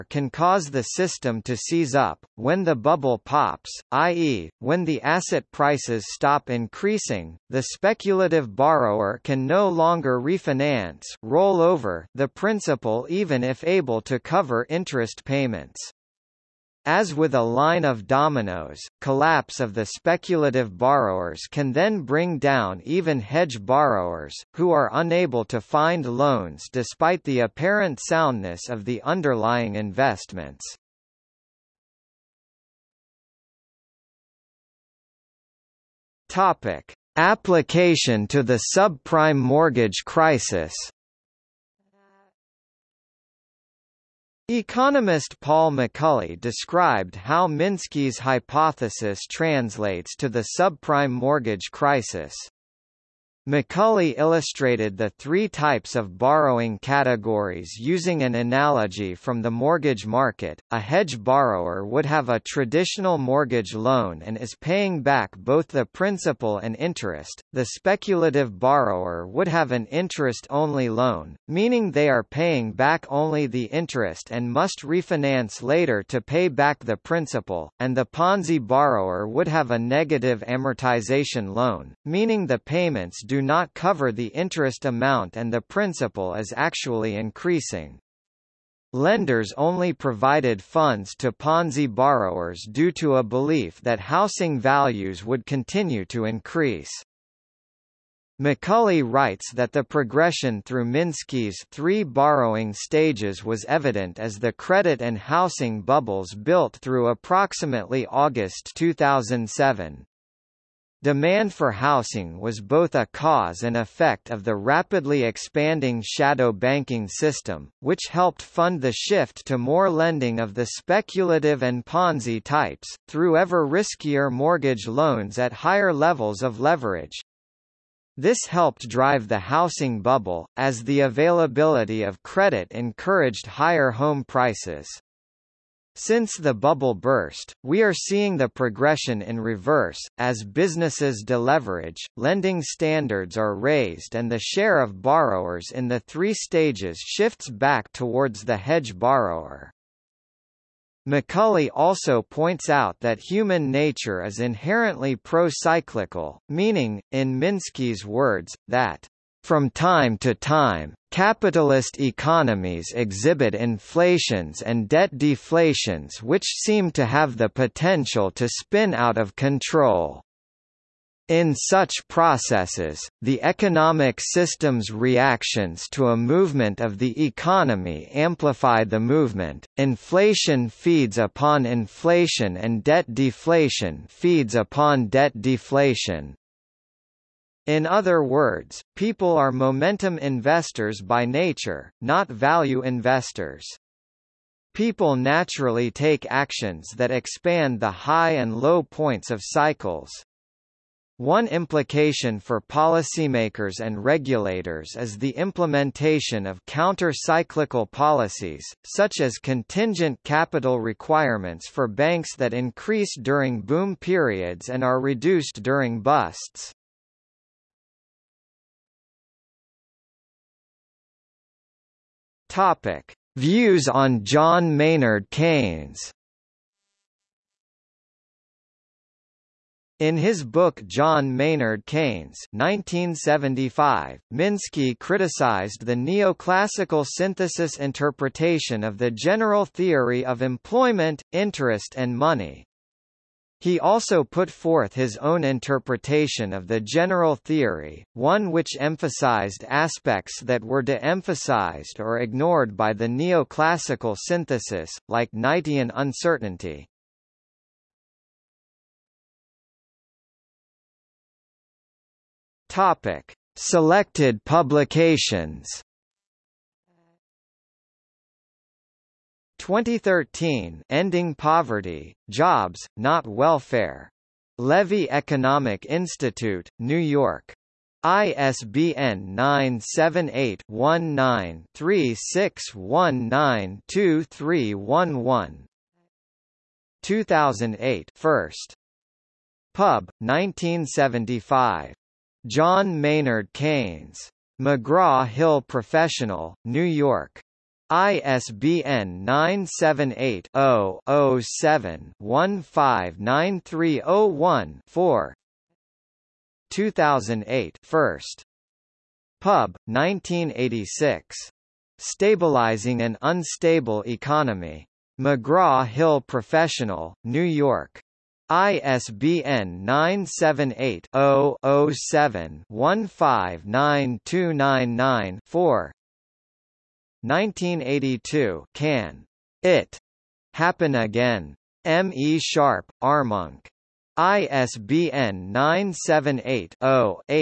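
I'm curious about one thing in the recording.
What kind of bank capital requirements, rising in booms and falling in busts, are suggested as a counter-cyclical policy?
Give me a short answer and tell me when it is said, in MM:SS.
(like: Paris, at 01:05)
Contingent capital requirements, at 03:29.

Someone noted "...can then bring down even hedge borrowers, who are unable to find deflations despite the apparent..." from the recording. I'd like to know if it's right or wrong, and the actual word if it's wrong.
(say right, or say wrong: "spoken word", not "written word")
wrong: "loans", not "deflations".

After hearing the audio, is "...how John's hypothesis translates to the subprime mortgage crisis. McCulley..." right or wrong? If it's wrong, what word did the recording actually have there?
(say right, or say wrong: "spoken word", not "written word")
wrong: "Minsky", not "John".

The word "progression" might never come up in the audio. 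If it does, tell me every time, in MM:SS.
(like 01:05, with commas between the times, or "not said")
01:39, 02:18.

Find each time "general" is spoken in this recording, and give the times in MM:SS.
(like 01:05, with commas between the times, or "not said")
03:59, 04:06.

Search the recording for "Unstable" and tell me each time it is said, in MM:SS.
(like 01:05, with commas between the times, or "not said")
05:13.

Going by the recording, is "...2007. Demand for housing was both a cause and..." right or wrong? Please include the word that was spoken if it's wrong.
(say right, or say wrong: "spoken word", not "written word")
right.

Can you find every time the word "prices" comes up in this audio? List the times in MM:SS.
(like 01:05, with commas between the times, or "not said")
00:05, 02:14.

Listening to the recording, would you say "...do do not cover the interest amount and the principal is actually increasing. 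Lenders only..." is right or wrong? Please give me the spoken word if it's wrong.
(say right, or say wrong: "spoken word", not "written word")
right.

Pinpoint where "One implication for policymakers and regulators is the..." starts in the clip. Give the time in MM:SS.
03:21.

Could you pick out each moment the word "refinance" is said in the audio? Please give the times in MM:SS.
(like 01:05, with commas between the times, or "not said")
00:10, 01:14.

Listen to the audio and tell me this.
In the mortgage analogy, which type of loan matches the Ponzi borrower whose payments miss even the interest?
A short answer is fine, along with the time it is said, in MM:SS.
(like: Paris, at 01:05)
Negative amortization loan, at 01:19.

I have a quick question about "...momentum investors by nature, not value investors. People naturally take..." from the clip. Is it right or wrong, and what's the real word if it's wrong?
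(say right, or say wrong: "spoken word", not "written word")
right.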